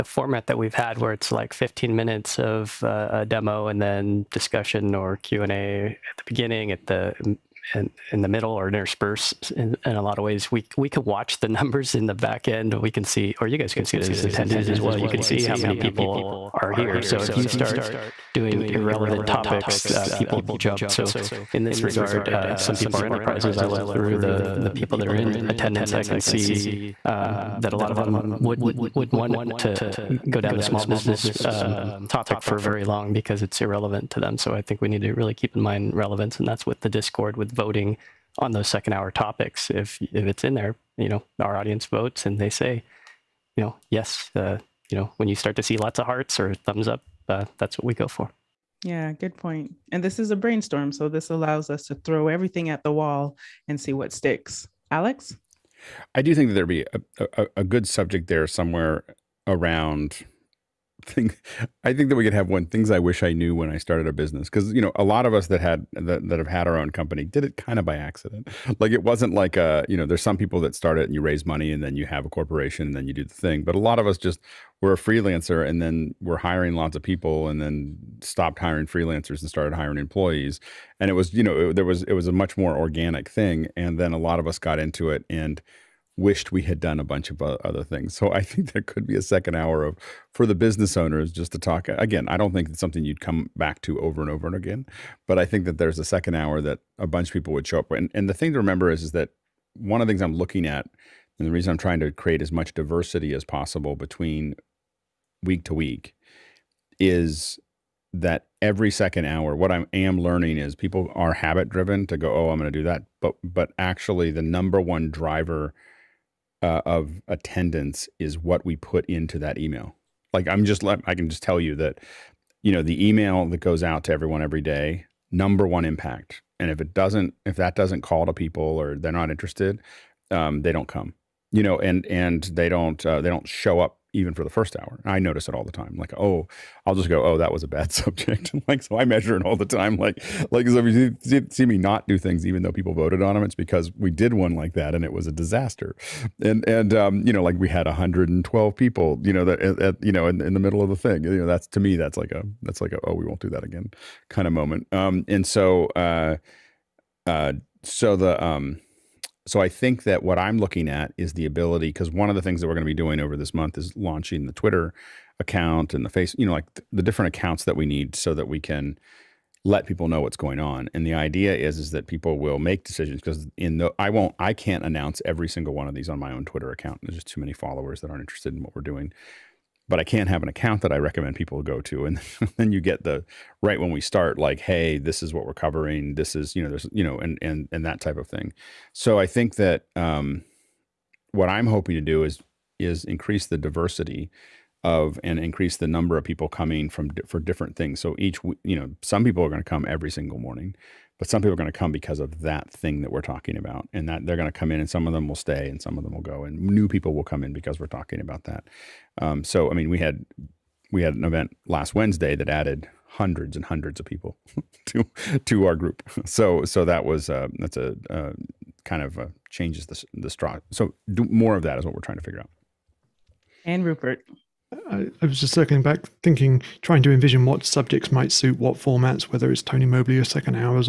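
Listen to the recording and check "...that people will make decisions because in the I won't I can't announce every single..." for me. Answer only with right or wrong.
right.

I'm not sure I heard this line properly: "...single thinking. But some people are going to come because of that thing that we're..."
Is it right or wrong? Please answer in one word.
wrong.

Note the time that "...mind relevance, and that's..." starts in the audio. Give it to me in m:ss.
0:35.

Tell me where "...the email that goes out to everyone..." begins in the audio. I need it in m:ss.
2:02.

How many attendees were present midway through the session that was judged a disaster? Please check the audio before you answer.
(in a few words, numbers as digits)
112.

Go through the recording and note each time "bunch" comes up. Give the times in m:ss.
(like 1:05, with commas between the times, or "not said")
1:27, 1:37.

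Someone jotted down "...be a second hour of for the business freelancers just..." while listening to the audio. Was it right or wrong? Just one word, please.
wrong.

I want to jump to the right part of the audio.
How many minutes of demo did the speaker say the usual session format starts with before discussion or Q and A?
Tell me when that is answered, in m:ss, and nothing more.
0:01.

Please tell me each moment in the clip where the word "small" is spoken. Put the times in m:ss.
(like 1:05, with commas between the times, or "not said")
0:30.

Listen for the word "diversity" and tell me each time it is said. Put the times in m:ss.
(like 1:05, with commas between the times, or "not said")
1:42, 3:13.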